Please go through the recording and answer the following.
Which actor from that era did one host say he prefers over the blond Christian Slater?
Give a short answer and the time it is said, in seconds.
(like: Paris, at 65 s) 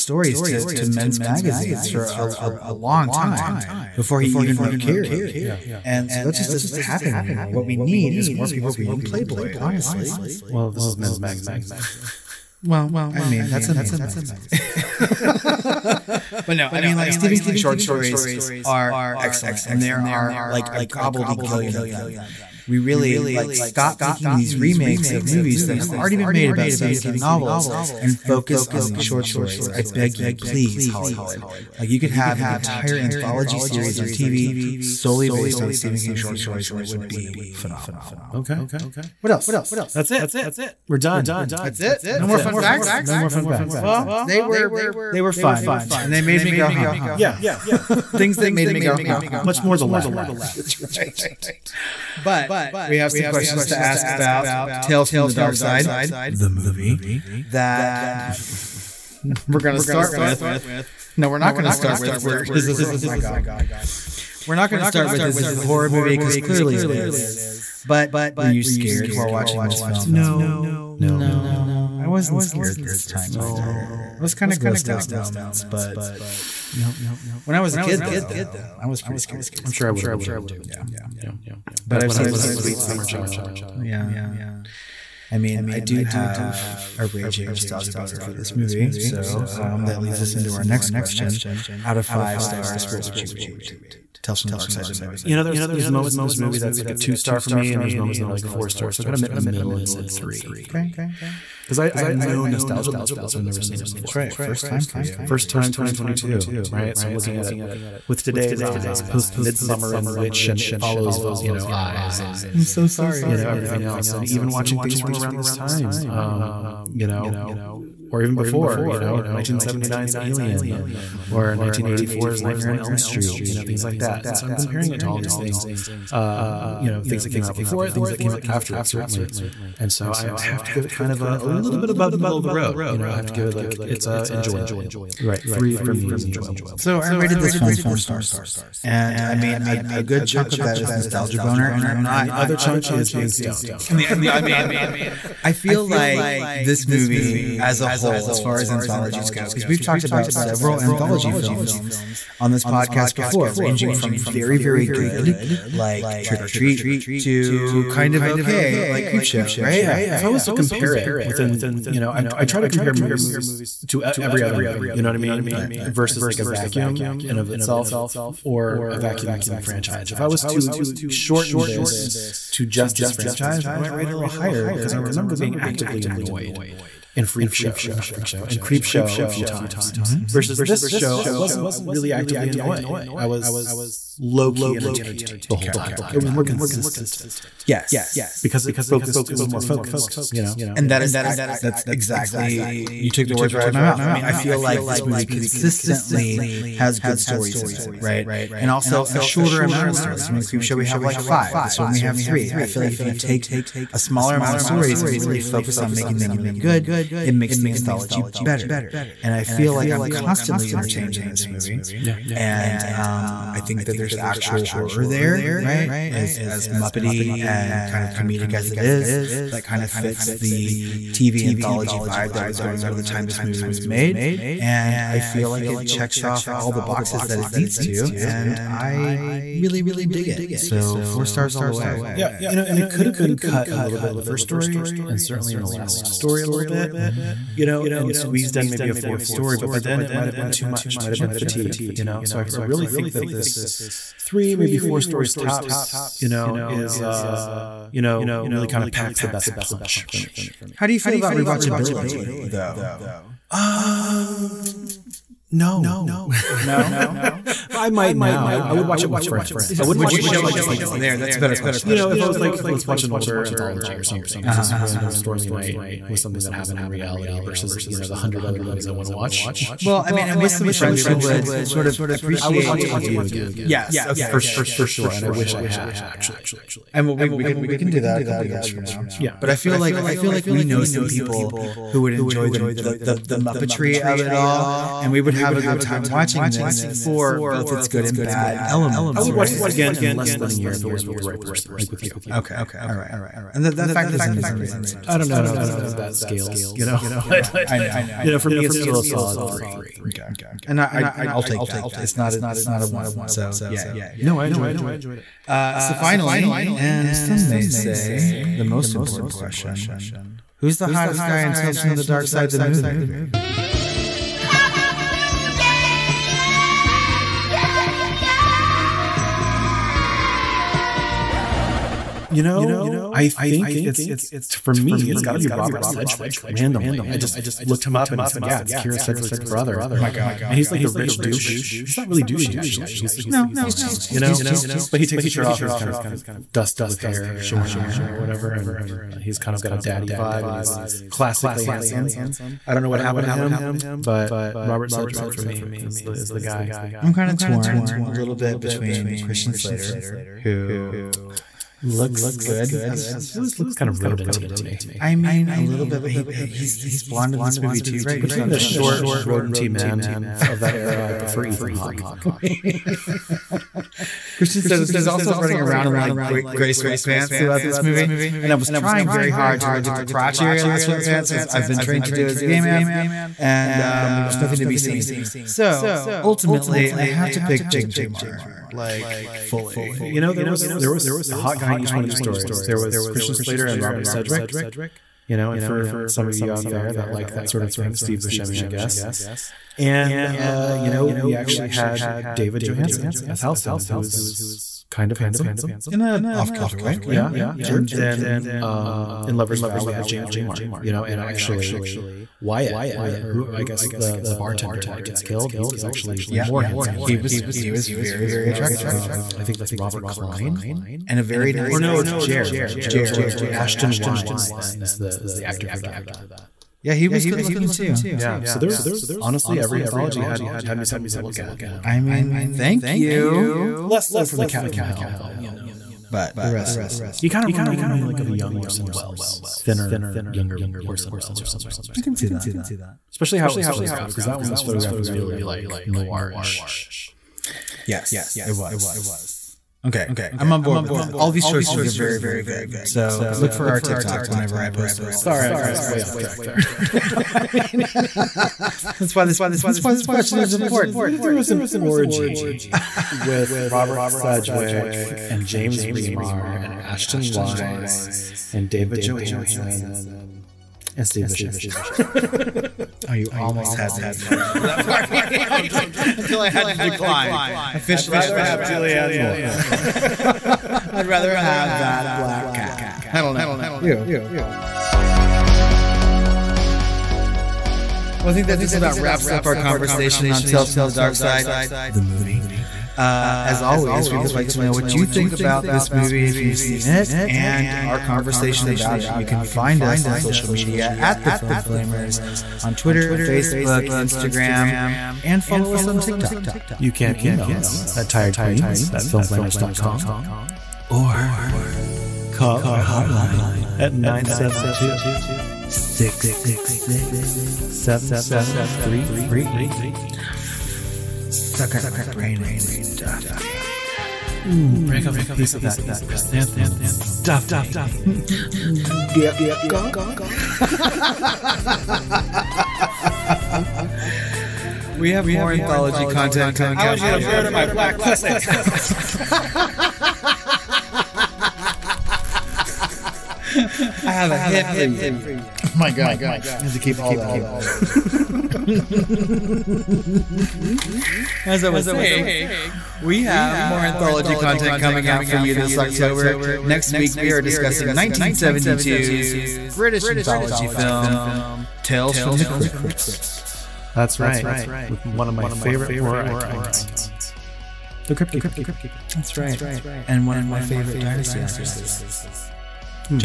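Ethan Hawke, at 361 s.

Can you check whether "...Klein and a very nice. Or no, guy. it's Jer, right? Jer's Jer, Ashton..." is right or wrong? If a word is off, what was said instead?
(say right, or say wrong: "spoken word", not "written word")
right.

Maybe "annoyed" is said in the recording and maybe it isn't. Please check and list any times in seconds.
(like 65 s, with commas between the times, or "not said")
176 s, 182 s.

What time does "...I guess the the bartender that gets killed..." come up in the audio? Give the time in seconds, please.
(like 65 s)
403 s.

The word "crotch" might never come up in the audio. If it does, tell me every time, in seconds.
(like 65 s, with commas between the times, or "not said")
370 s.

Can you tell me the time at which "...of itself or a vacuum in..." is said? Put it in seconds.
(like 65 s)
167 s.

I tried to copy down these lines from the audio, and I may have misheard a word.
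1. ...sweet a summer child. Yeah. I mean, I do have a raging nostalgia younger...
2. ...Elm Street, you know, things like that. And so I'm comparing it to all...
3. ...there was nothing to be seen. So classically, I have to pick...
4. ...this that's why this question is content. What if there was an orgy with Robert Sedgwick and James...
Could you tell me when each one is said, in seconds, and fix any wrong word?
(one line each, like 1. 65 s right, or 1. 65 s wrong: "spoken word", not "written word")
1. 82 s wrong: "boner", not "younger"
2. 122 s right
3. 374 s wrong: "ultimately", not "classically"
4. 449 s wrong: "important", not "content".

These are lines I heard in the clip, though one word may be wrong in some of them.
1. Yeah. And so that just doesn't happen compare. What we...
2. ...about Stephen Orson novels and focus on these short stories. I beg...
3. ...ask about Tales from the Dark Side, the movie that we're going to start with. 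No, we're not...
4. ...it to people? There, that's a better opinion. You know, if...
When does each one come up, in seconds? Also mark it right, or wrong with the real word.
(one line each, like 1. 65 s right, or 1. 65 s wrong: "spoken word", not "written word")
1. 5 s wrong: "anymore", not "compare"
2. 26 s wrong: "King", not "Orson"
3. 53 s right
4. 260 s wrong: "question", not "opinion".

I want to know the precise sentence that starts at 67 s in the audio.
But were you scared while watching this film?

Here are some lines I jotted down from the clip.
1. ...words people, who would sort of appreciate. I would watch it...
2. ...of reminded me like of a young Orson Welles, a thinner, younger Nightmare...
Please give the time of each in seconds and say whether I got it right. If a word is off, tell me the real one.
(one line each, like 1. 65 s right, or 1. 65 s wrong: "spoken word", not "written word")
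1. 270 s wrong: "friends", not "words"
2. 427 s wrong: "Orson", not "Nightmare".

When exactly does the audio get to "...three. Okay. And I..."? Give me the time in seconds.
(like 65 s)
299 s.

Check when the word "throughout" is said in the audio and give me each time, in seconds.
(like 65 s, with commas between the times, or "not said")
367 s.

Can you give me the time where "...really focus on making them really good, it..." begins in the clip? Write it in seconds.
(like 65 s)
205 s.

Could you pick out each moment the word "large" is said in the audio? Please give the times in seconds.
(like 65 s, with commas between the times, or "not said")
not said.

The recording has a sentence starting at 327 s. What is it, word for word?
I just looked him up and it's, yeah, it's Kyra Sedgwick's brother.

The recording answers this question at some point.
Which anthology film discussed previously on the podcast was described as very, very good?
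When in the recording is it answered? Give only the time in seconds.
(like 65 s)
156 s.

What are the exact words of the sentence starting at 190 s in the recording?
and that is that's exactly you took the words right out of my mouth.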